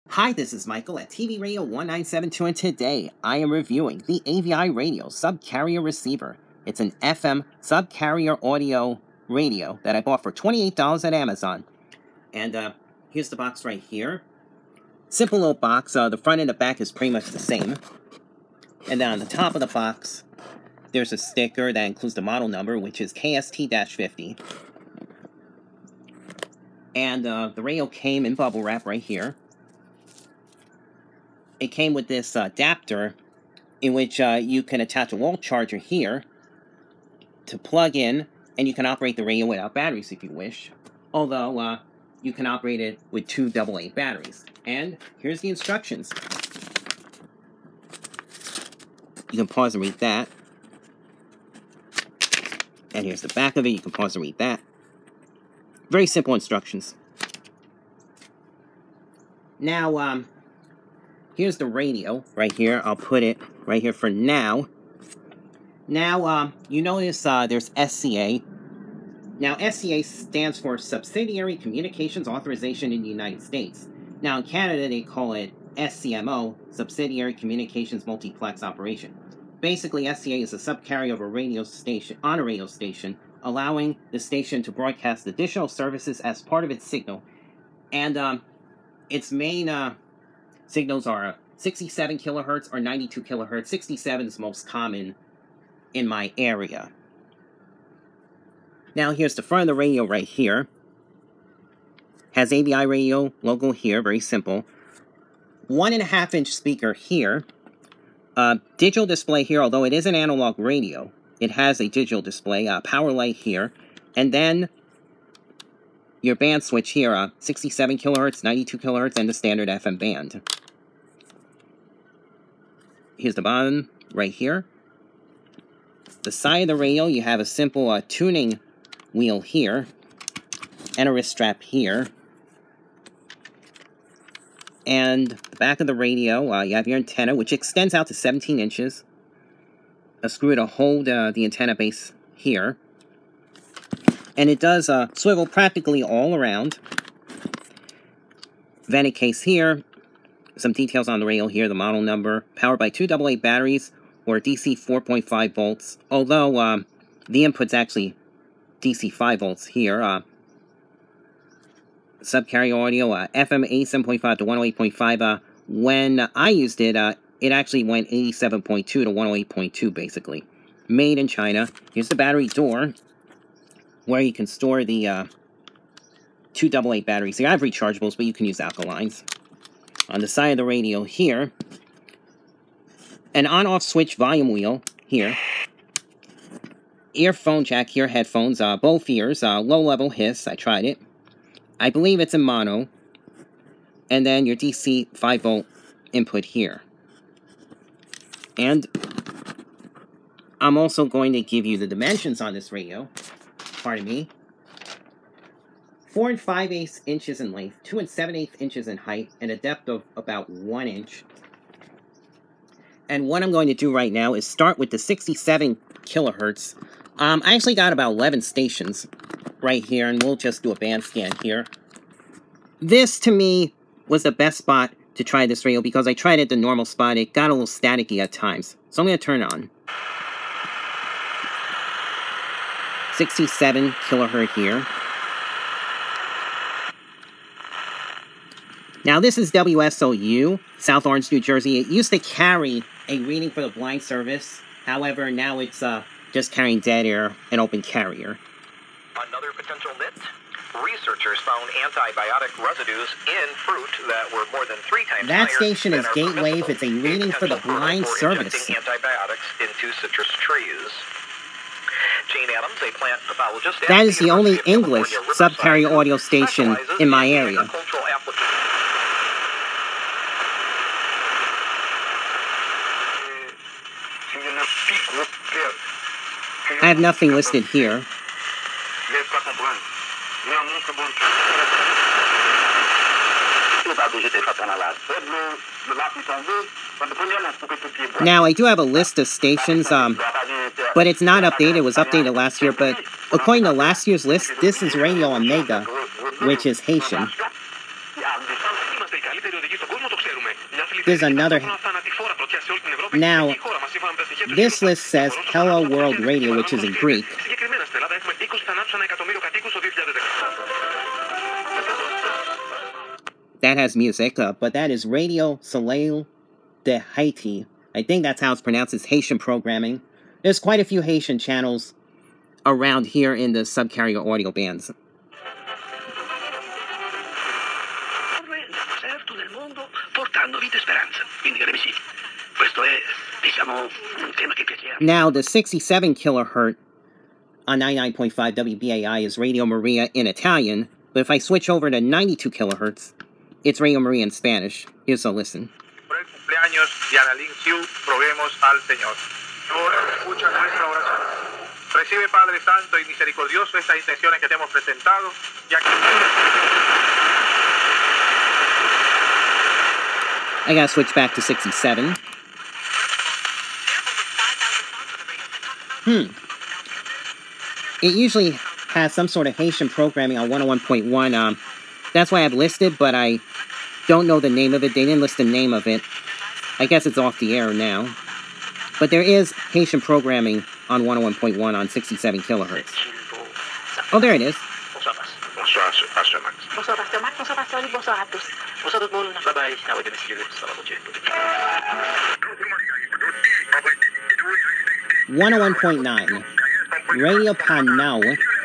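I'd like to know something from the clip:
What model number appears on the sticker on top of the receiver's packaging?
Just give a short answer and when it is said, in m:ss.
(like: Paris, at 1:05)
KST-50, at 0:23.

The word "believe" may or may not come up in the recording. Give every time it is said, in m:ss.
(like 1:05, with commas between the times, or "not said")
3:11.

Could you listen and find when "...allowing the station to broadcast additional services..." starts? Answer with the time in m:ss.
1:23.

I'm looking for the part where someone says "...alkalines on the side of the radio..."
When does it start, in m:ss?
2:58.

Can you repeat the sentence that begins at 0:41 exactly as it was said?
Although uh, you can operate it with two AA batteries.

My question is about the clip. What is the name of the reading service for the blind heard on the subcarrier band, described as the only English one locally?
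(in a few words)
Gatewave.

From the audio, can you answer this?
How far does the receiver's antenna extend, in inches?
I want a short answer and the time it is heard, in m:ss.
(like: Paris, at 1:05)
17 inches, at 2:18.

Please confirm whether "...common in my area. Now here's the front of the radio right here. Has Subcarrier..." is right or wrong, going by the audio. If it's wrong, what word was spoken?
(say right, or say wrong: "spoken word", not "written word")
wrong: "Avi", not "Subcarrier".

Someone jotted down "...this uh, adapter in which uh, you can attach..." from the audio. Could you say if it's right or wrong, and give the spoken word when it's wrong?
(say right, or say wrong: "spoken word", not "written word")
right.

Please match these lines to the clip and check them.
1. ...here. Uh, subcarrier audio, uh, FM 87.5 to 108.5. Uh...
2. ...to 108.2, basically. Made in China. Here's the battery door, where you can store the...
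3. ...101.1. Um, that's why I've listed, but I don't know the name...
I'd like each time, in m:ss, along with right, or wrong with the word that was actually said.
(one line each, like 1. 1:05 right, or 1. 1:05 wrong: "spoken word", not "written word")
1. 2:39 right
2. 2:48 right
3. 6:10 right.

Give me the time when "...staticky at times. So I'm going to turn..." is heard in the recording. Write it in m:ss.
3:47.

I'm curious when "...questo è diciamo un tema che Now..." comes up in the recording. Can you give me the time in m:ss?
5:32.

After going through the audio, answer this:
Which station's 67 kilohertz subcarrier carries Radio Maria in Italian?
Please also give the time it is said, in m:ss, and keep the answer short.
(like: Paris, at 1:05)
WBAI, at 5:38.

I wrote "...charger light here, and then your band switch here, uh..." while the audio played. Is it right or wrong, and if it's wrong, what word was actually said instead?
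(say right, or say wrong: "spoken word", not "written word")
wrong: "power", not "charger".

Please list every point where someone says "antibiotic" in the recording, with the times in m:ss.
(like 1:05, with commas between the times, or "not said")
4:11, 4:18.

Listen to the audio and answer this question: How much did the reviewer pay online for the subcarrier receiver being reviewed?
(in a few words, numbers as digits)
$28.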